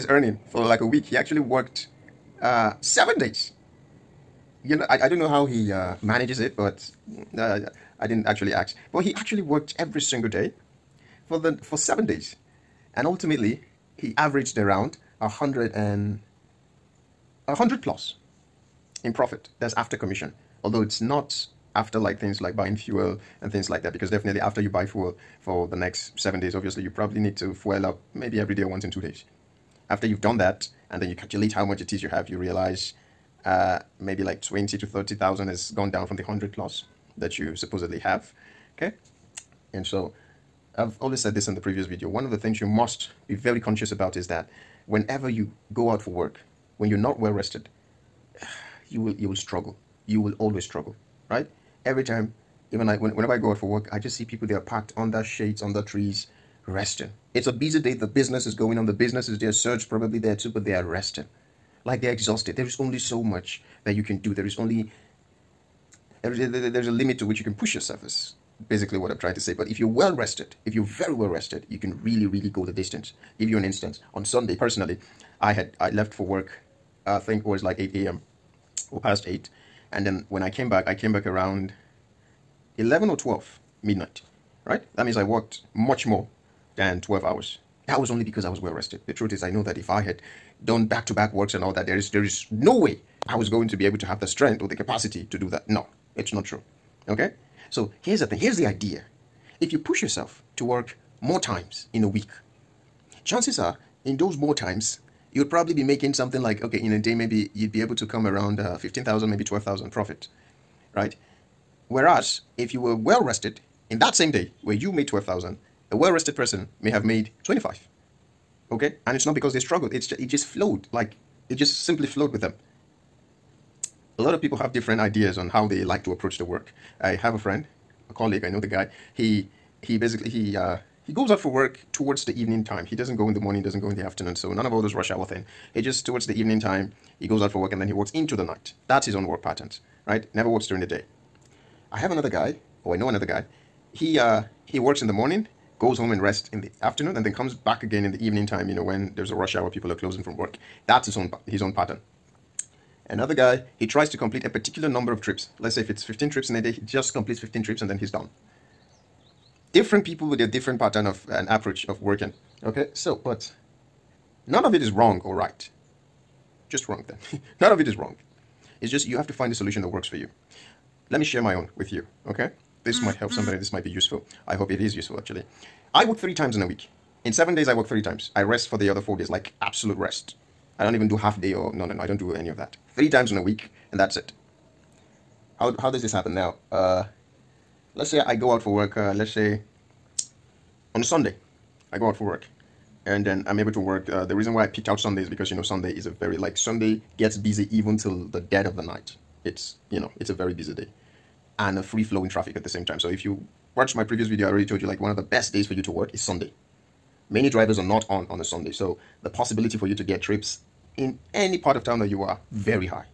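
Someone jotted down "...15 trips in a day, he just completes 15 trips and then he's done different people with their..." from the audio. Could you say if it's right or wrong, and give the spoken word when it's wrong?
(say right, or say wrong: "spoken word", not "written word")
right.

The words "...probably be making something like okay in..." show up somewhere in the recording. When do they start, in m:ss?
1:45.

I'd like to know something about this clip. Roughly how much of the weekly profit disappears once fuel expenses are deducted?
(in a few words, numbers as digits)
20 to 30,000.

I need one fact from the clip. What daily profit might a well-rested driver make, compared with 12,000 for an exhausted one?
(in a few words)
25.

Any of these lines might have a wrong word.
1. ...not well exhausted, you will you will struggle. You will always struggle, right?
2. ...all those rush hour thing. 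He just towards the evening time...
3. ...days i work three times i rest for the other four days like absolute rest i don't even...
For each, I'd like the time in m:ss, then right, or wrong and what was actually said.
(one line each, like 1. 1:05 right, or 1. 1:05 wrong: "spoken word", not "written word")
1. 0:46 wrong: "rested", not "exhausted"
2. 2:14 right
3. 2:57 right.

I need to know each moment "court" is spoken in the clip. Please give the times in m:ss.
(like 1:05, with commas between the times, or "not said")
not said.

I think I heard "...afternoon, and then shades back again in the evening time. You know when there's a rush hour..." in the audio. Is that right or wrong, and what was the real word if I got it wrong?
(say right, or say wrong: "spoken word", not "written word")
wrong: "comes", not "shades".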